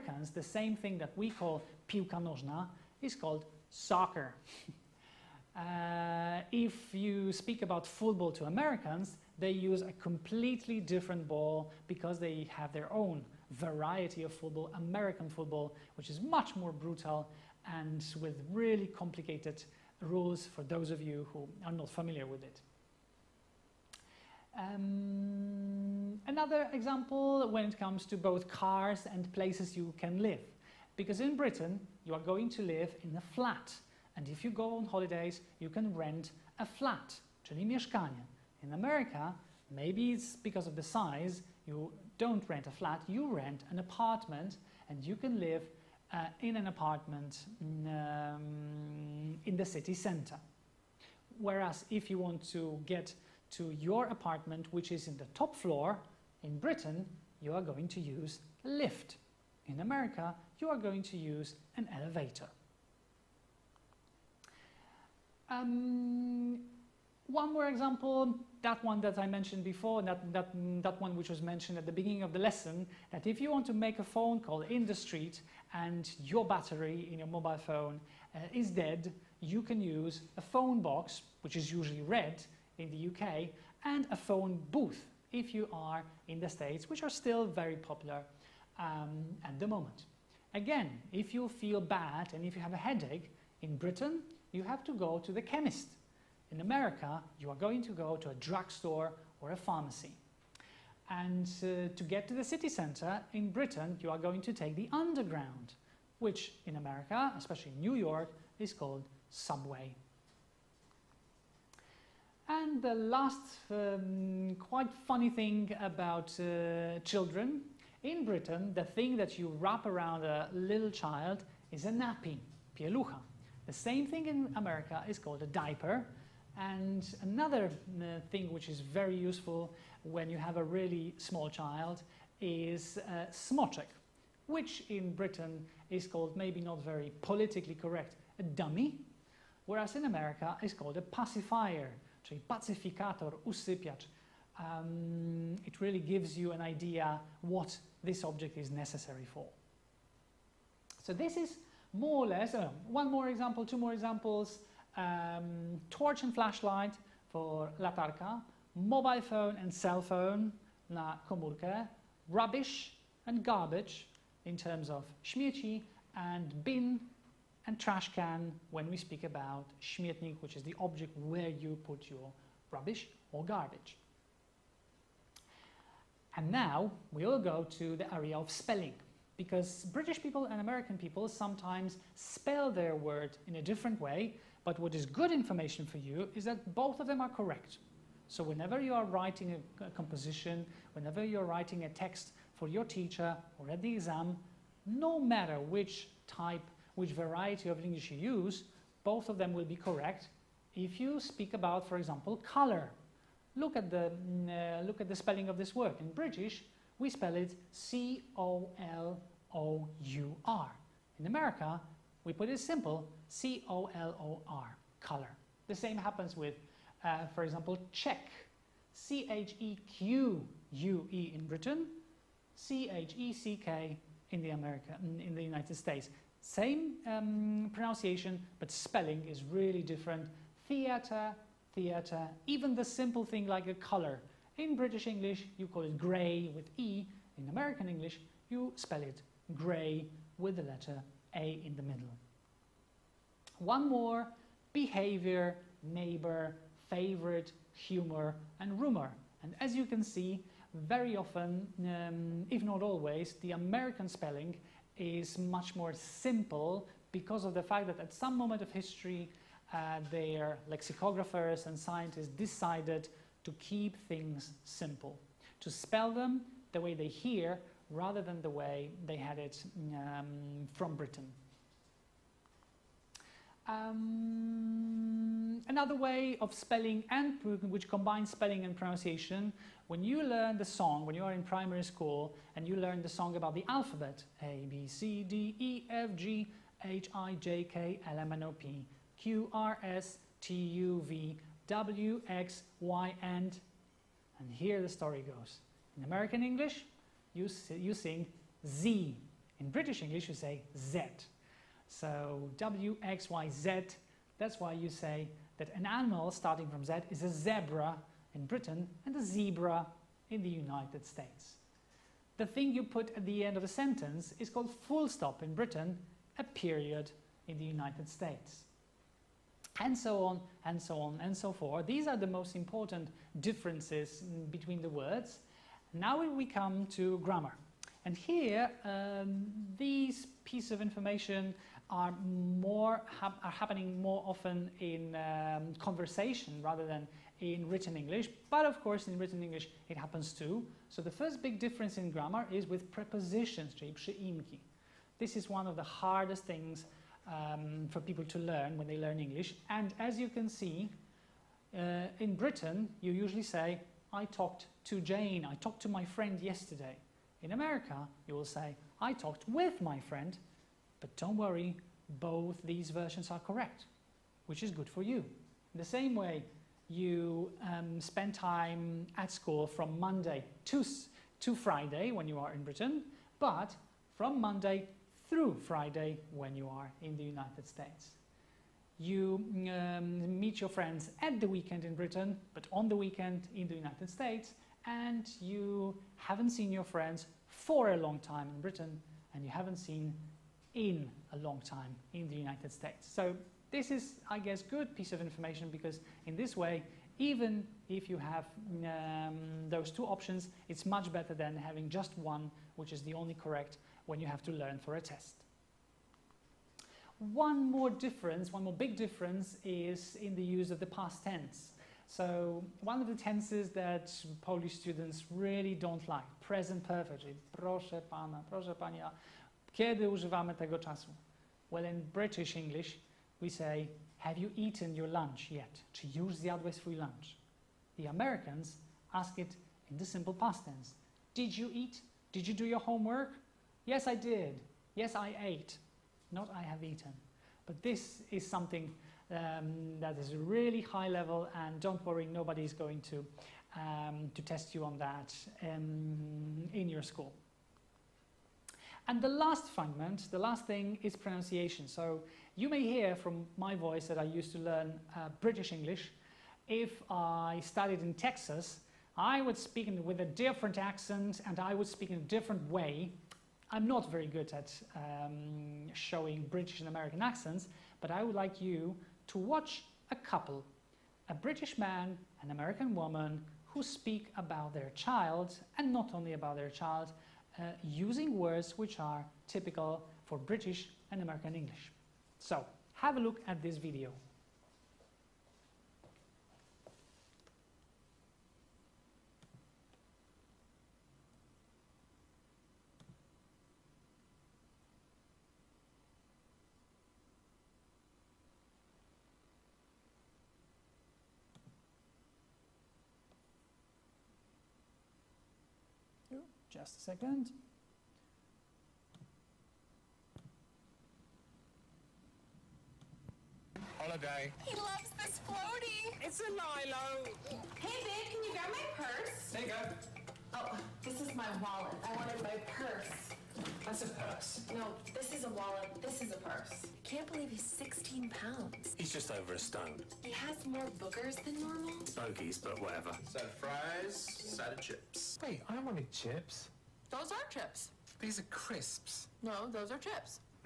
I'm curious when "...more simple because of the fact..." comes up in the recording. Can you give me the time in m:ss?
4:15.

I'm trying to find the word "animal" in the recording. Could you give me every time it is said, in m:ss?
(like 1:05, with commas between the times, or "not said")
5:05.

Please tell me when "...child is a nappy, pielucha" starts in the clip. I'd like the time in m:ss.
2:00.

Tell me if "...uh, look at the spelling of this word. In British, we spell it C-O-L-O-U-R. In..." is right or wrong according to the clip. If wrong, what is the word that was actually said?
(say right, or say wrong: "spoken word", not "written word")
right.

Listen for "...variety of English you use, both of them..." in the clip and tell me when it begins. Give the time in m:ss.
3:17.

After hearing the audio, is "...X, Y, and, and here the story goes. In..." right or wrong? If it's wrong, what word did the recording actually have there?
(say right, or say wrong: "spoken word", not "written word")
right.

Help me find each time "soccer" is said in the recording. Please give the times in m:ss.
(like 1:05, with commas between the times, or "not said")
0:03.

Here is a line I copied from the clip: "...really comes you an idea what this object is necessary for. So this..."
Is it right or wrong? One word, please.
wrong.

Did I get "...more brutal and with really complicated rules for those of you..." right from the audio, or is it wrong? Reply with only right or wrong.
right.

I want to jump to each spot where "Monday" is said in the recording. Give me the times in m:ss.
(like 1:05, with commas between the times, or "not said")
6:09, 6:14.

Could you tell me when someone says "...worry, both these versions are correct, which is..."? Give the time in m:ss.
6:01.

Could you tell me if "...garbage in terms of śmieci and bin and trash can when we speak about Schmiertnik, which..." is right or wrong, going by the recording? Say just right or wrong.
right.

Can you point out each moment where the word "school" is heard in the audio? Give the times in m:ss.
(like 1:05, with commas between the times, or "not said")
4:41, 6:09, 7:27.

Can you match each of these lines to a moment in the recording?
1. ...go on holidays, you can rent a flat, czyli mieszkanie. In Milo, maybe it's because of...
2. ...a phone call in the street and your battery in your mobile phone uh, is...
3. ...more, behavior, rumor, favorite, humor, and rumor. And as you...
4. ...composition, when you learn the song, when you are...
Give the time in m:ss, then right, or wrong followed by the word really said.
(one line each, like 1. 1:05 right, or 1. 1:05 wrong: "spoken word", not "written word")
1. 0:34 wrong: "America", not "Milo"
2. 1:13 right
3. 4:03 wrong: "neighbor", not "rumor"
4. 4:38 wrong: "pronunciation", not "composition".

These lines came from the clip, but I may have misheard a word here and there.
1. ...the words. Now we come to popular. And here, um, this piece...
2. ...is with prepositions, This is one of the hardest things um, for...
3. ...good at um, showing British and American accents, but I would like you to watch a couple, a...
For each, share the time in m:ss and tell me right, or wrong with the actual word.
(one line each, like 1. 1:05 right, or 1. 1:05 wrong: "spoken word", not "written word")
1. 5:24 wrong: "grammar", not "popular"
2. 5:42 right
3. 7:44 right.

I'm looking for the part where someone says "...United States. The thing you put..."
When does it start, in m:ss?
5:10.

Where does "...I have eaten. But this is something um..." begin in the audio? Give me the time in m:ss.
7:16.